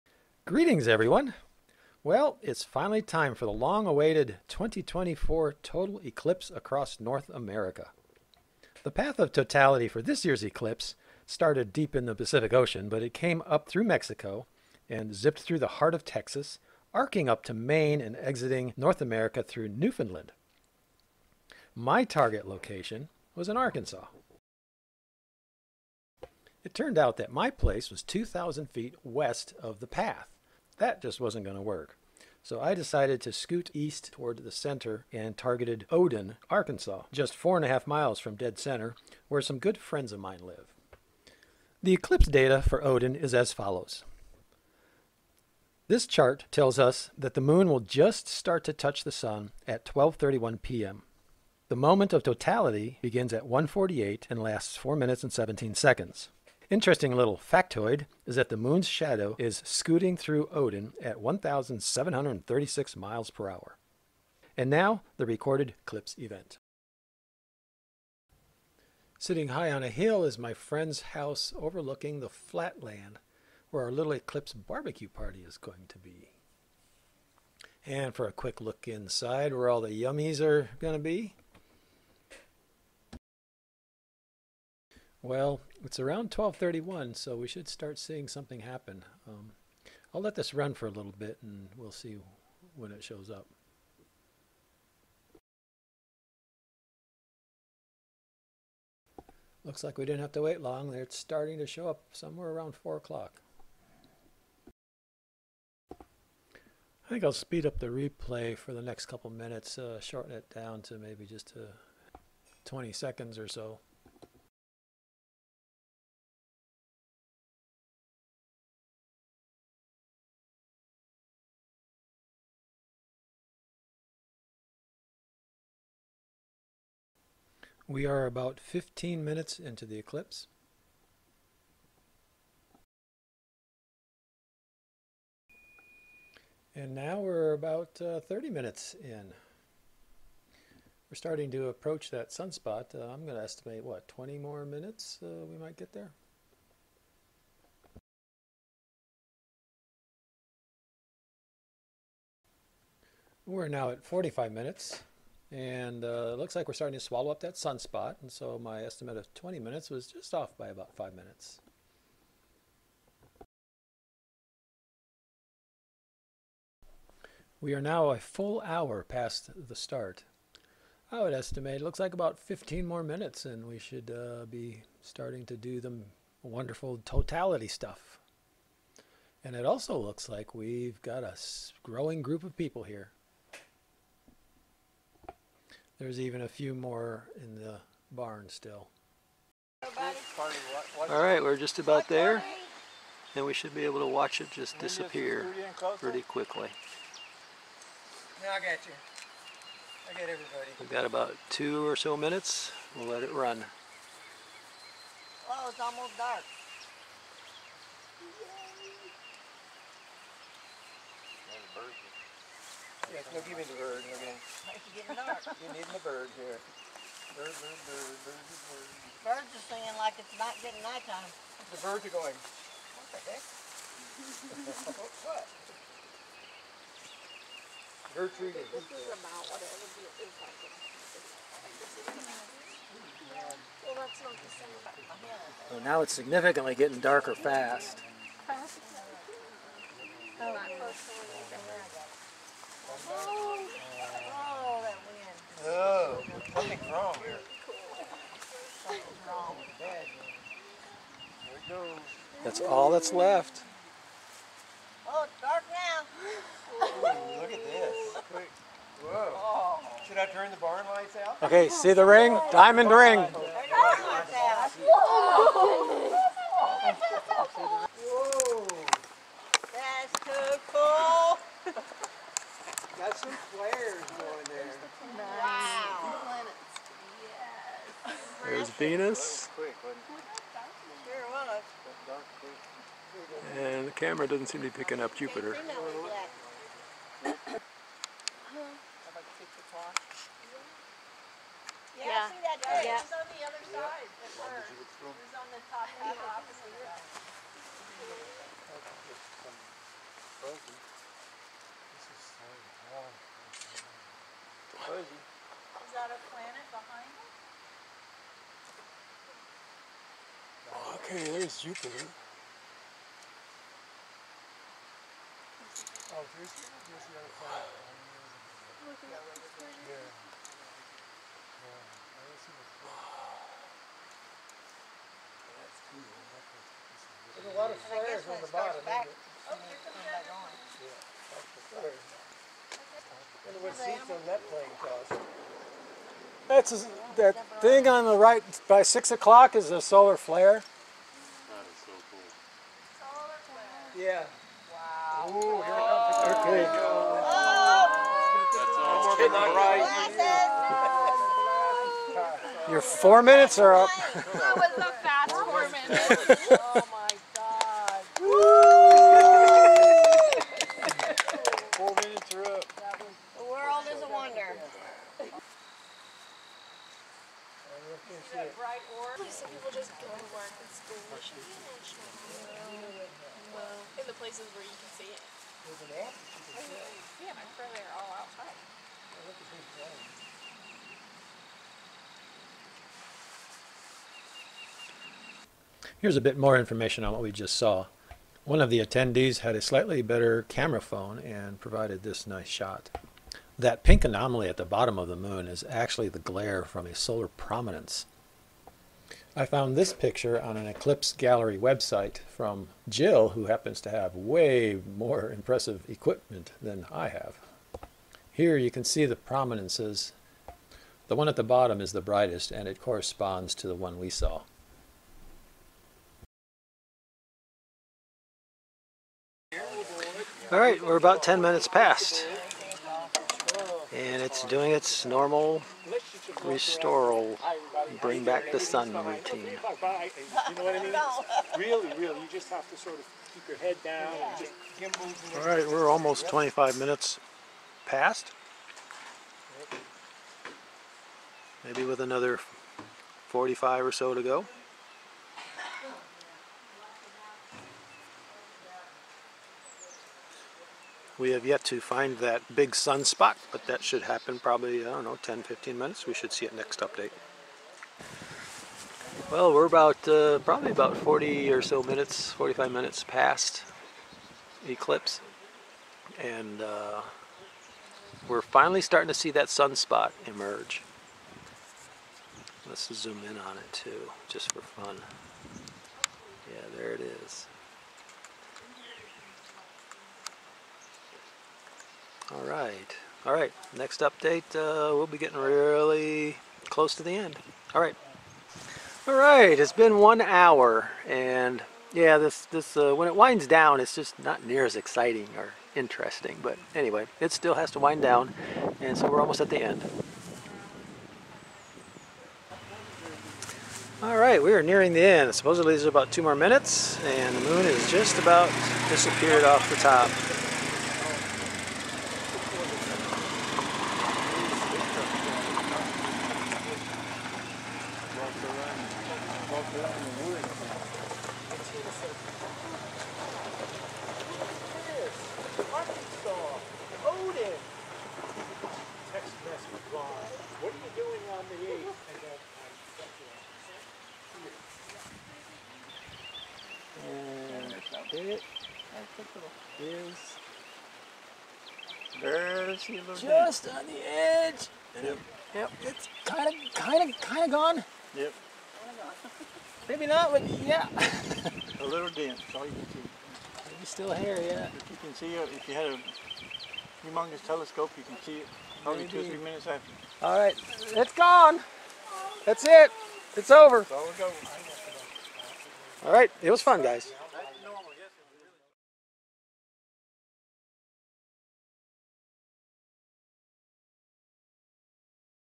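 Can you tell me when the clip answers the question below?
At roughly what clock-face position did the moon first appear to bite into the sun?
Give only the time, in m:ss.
1:42.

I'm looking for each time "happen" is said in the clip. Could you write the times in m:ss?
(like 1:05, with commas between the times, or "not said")
1:28, 6:43, 7:34.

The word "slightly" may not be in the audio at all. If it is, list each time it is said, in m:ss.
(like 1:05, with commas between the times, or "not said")
6:29.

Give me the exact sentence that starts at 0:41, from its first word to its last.
The eclipse data for Oden is as follows.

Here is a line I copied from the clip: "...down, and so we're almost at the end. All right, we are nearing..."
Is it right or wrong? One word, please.
right.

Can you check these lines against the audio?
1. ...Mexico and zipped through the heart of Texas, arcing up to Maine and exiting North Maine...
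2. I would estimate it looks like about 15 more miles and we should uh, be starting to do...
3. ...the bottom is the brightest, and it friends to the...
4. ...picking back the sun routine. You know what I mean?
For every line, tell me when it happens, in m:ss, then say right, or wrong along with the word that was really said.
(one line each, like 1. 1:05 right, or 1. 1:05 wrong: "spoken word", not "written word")
1. 0:13 wrong: "America", not "Maine"
2. 2:51 wrong: "minutes", not "miles"
3. 6:51 wrong: "corresponds", not "friends"
4. 7:08 wrong: "bring", not "picking".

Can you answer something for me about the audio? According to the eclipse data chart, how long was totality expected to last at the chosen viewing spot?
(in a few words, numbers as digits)
4 minutes and 17 seconds.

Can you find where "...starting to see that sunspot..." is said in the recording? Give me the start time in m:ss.
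7:48.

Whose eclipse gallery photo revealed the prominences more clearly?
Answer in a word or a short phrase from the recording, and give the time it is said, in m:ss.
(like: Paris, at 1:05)
Jill, at 6:42.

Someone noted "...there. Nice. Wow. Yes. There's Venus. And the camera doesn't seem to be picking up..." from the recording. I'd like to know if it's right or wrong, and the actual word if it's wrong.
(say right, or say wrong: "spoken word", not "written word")
right.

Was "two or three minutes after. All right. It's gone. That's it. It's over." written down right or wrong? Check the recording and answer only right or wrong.
right.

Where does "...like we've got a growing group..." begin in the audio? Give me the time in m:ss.
3:00.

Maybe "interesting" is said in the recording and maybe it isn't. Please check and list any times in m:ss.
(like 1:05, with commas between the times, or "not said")
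0:56, 8:15.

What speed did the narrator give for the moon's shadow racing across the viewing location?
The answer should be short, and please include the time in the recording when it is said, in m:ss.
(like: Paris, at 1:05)
1,736 miles per hour, at 1:01.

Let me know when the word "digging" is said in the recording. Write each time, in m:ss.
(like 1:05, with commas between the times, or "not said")
not said.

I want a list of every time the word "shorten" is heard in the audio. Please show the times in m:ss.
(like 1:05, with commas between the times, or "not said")
1:49.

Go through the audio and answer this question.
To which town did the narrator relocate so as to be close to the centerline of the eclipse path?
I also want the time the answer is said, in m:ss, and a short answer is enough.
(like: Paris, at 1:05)
Oden, Arkansas, at 0:35.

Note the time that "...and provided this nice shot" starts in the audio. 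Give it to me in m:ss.
6:31.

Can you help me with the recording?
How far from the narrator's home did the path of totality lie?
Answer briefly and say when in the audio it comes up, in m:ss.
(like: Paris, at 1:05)
2,000 feet west, at 0:28.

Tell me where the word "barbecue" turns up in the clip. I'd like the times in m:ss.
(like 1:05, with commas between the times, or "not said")
1:14.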